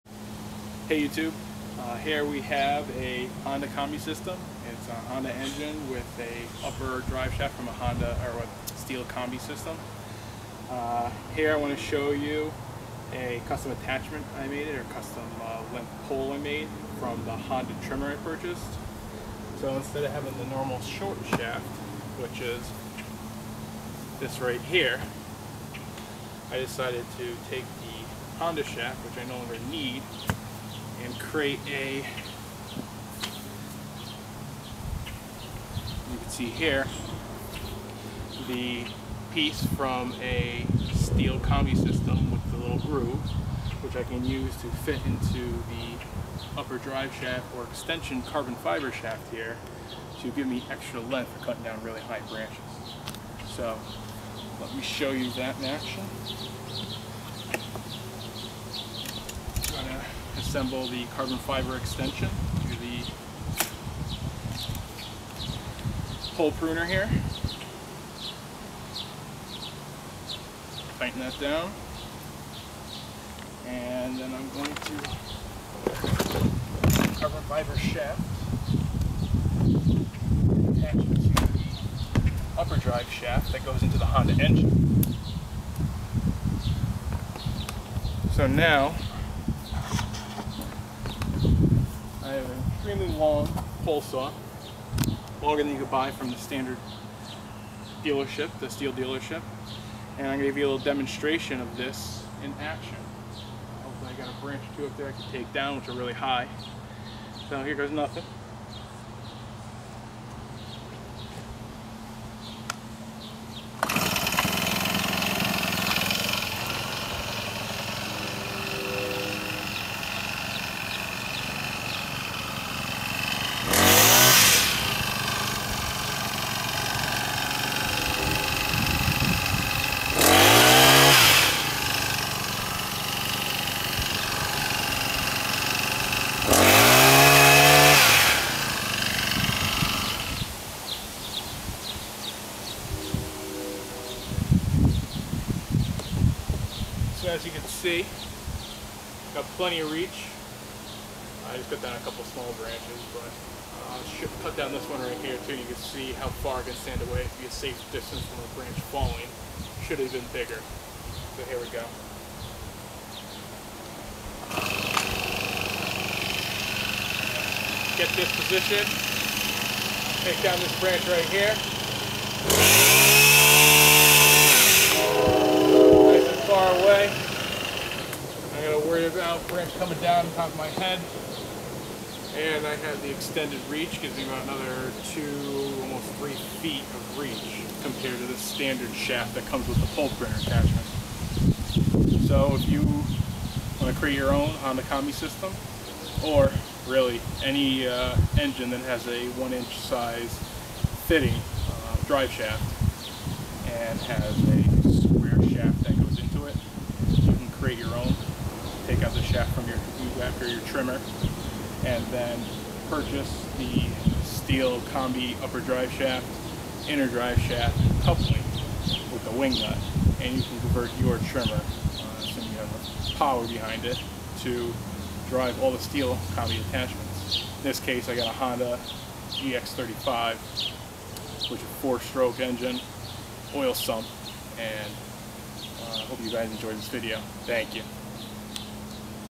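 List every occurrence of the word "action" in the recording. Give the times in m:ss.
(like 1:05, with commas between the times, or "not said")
0:55, 1:42.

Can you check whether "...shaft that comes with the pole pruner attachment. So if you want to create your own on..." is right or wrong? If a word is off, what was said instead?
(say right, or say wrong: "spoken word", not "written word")
right.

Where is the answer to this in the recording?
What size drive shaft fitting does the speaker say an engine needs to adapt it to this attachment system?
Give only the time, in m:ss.
3:19.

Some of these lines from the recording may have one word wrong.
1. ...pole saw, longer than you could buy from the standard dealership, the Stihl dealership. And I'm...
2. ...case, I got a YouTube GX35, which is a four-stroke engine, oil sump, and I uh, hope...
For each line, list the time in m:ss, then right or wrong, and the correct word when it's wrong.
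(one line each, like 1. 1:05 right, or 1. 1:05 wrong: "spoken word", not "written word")
1. 1:33 right
2. 3:47 wrong: "Honda", not "YouTube".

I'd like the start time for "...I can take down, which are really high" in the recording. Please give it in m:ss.
1:45.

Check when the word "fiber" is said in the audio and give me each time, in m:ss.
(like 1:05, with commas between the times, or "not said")
0:48, 1:01, 1:17.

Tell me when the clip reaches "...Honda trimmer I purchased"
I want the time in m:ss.
0:17.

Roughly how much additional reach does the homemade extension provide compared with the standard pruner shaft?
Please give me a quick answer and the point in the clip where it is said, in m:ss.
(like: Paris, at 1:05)
Almost 3 feet, at 3:05.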